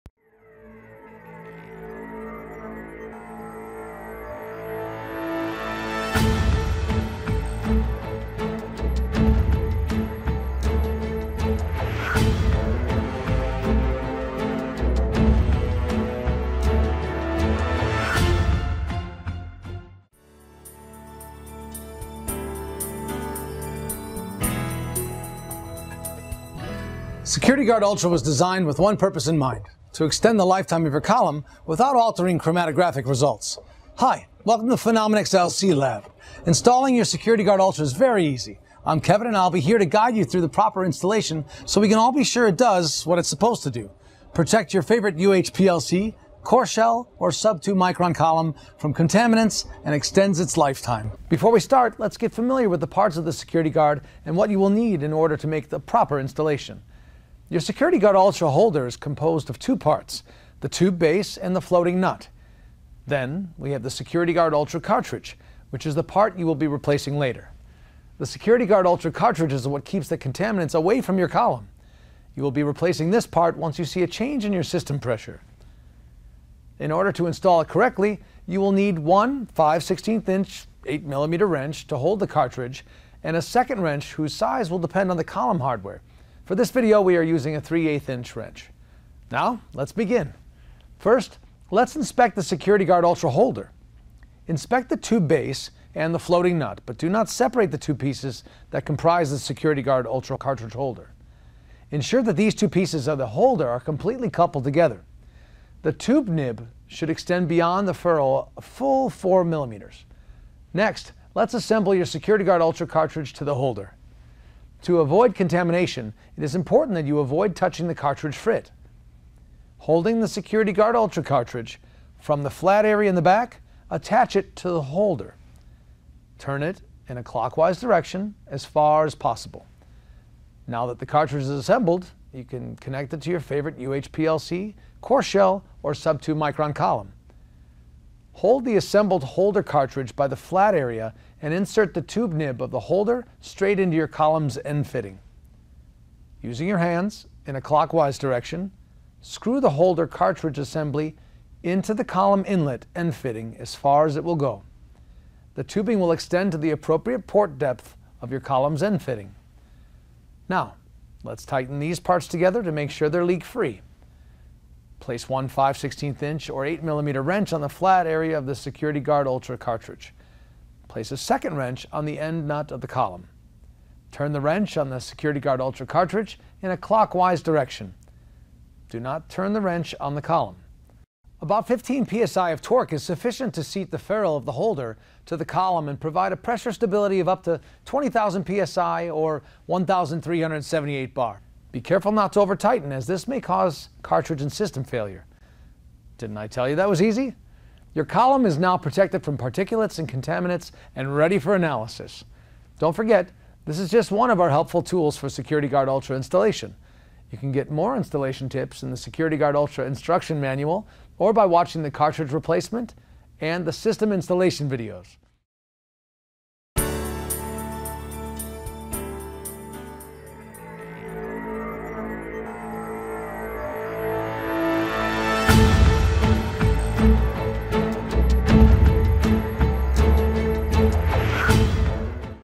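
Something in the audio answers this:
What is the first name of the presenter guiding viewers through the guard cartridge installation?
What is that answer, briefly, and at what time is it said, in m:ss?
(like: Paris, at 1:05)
Kevin, at 0:38.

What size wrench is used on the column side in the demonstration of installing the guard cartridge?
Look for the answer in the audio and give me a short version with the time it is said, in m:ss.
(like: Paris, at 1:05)
3/8 inch, at 1:27.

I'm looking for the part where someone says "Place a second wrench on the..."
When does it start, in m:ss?
2:50.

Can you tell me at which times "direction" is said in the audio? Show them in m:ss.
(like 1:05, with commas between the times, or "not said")
2:07, 2:28, 2:57.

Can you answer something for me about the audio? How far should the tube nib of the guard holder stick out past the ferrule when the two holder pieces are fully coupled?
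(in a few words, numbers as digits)
4 millimeters.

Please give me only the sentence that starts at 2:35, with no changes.
The tubing will extend to the appropriate port depth of your column's end fitting.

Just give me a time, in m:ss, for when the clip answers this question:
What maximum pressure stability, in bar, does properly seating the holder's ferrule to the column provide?
3:09.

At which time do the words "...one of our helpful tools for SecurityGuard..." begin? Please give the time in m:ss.
3:24.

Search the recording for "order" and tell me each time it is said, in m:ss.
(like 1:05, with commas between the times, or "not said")
0:55, 1:16.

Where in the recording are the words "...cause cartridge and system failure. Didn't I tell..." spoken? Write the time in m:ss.
3:13.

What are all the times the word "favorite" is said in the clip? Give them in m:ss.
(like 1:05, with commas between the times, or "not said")
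0:44, 2:13.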